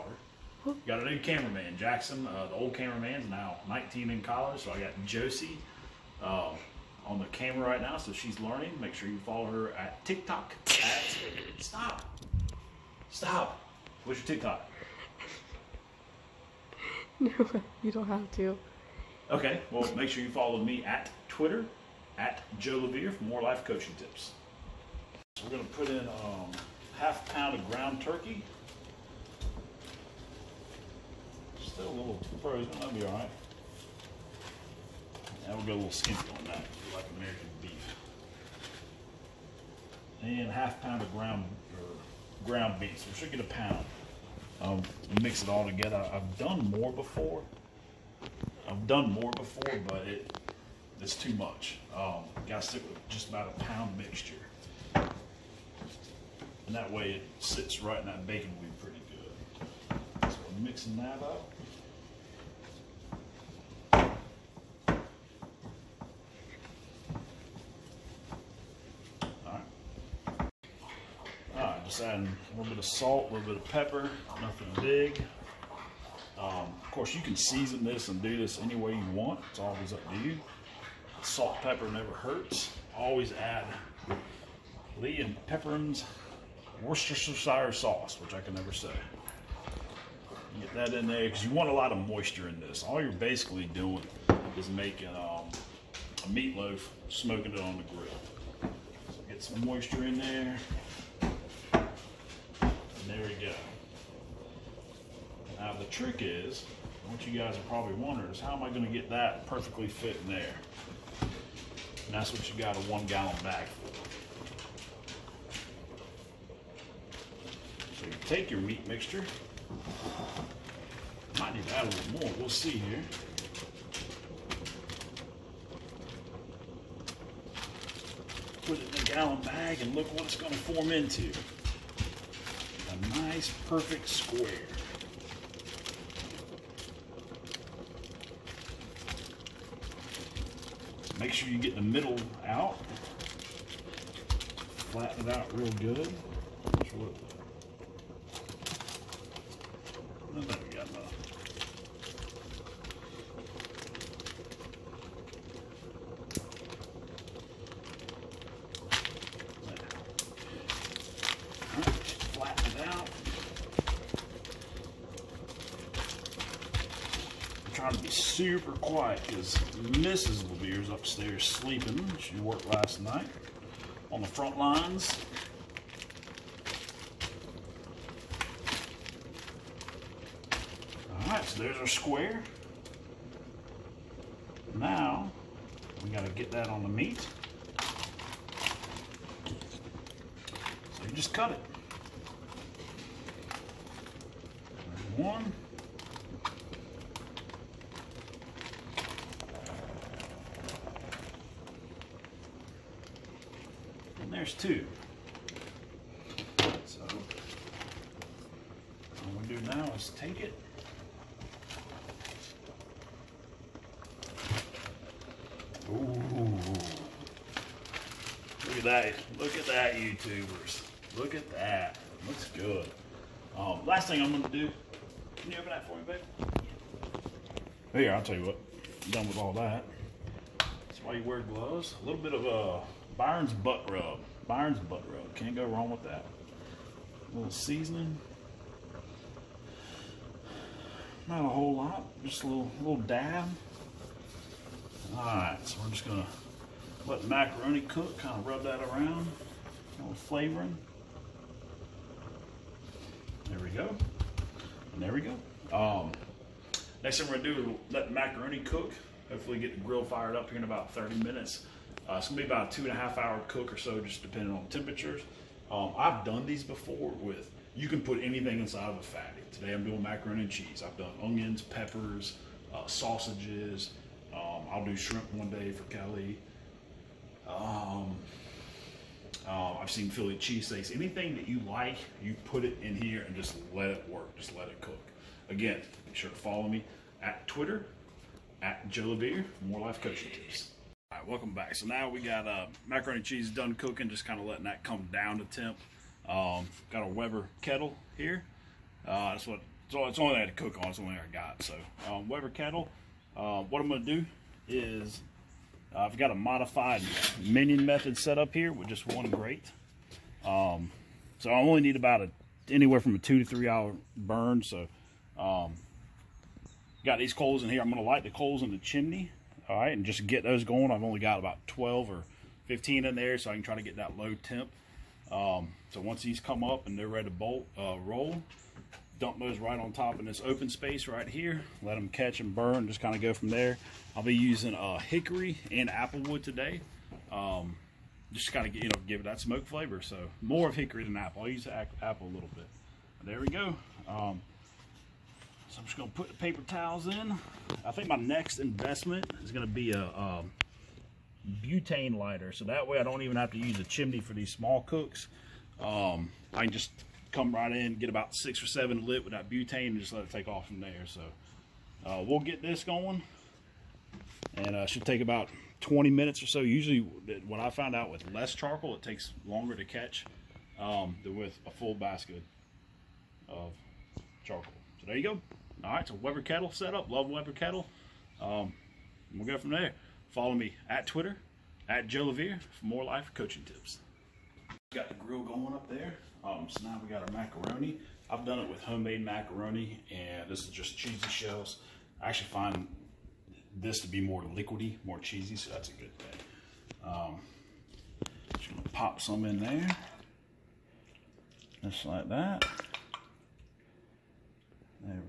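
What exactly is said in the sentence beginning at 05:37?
Um, just kind of you know give it that smoke flavor.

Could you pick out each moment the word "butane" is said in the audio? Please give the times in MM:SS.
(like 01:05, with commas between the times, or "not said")
05:51, 05:59.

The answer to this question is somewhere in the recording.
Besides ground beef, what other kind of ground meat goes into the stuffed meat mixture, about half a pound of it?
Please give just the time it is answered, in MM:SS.
00:27.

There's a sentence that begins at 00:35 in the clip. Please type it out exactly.
Now we'll go a little skimpy on that, like American beef.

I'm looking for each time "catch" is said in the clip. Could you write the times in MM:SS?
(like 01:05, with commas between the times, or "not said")
05:32, 06:09.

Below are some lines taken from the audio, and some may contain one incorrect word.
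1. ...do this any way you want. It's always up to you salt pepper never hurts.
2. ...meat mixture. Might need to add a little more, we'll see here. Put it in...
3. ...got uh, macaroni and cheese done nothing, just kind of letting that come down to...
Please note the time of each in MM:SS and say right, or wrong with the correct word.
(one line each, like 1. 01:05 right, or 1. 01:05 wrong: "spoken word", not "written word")
1. 01:18 right
2. 01:58 right
3. 04:52 wrong: "cooking", not "nothing".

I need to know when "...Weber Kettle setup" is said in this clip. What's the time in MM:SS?
06:16.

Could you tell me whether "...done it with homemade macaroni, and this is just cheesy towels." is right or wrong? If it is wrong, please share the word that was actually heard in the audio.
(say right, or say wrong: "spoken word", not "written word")
wrong: "shells", not "towels".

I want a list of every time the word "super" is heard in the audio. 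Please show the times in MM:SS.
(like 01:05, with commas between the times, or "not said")
02:48.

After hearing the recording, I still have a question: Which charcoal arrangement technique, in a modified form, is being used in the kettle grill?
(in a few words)
minion method.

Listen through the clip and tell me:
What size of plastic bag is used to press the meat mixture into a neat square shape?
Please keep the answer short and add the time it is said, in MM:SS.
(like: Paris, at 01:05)
one gallon, at 01:52.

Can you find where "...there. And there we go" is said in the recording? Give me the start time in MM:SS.
01:40.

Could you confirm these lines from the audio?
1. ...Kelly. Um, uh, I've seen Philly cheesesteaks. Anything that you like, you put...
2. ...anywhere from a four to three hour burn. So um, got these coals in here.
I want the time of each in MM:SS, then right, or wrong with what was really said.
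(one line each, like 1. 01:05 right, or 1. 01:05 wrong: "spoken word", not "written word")
1. 04:35 right
2. 05:12 wrong: "two", not "four".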